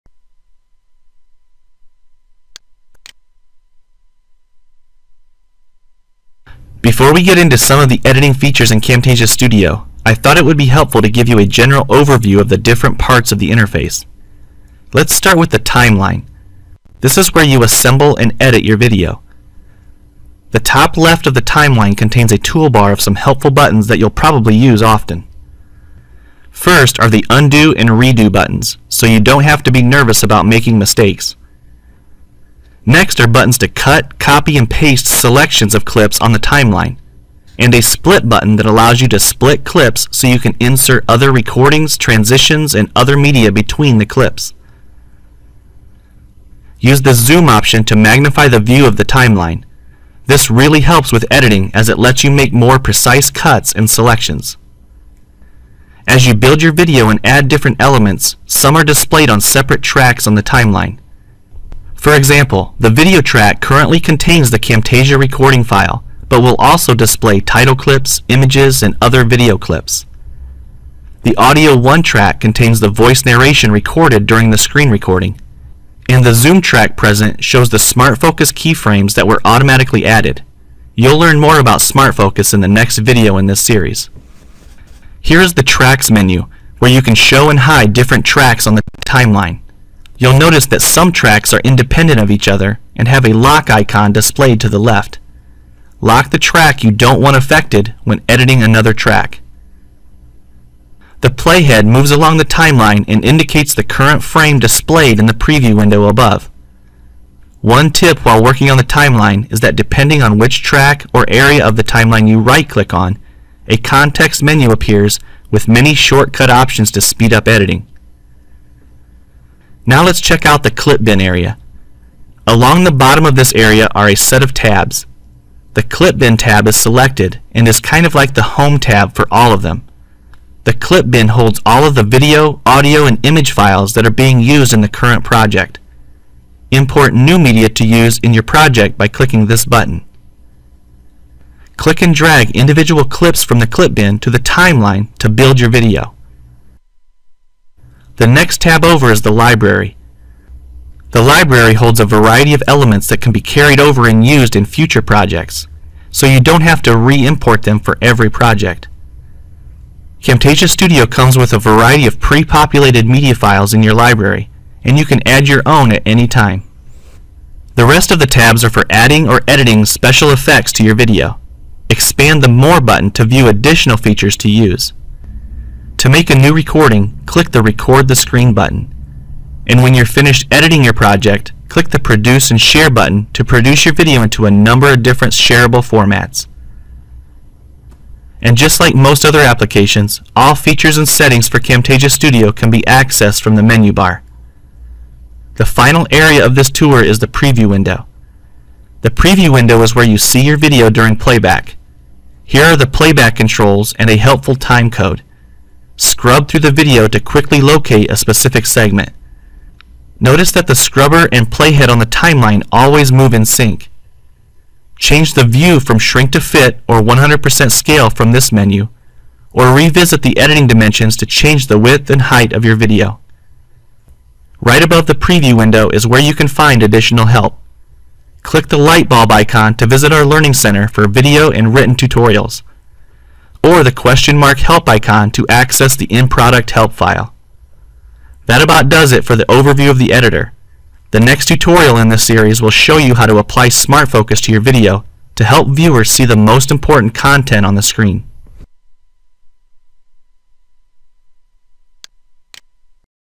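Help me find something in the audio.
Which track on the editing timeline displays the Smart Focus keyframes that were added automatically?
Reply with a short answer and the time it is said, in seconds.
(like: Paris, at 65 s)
Zoom track, at 76 s.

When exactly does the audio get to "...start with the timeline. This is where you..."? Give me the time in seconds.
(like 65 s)
15 s.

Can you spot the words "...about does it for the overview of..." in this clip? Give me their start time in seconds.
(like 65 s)
238 s.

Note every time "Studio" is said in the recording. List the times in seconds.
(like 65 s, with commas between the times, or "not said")
9 s, 160 s, 192 s.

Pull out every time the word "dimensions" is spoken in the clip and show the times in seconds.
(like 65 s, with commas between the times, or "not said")
220 s.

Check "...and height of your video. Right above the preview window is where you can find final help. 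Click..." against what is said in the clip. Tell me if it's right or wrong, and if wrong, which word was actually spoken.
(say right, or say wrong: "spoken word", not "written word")
wrong: "additional", not "final".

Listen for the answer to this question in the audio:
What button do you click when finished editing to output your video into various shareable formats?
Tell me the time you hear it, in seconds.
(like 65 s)
181 s.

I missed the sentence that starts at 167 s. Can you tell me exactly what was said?
The rest of the tabs are for adding or editing special effects to your video.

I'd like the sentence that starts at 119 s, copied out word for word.
Now let's check out the clip bin area.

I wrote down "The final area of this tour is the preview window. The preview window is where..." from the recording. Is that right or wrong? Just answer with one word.
right.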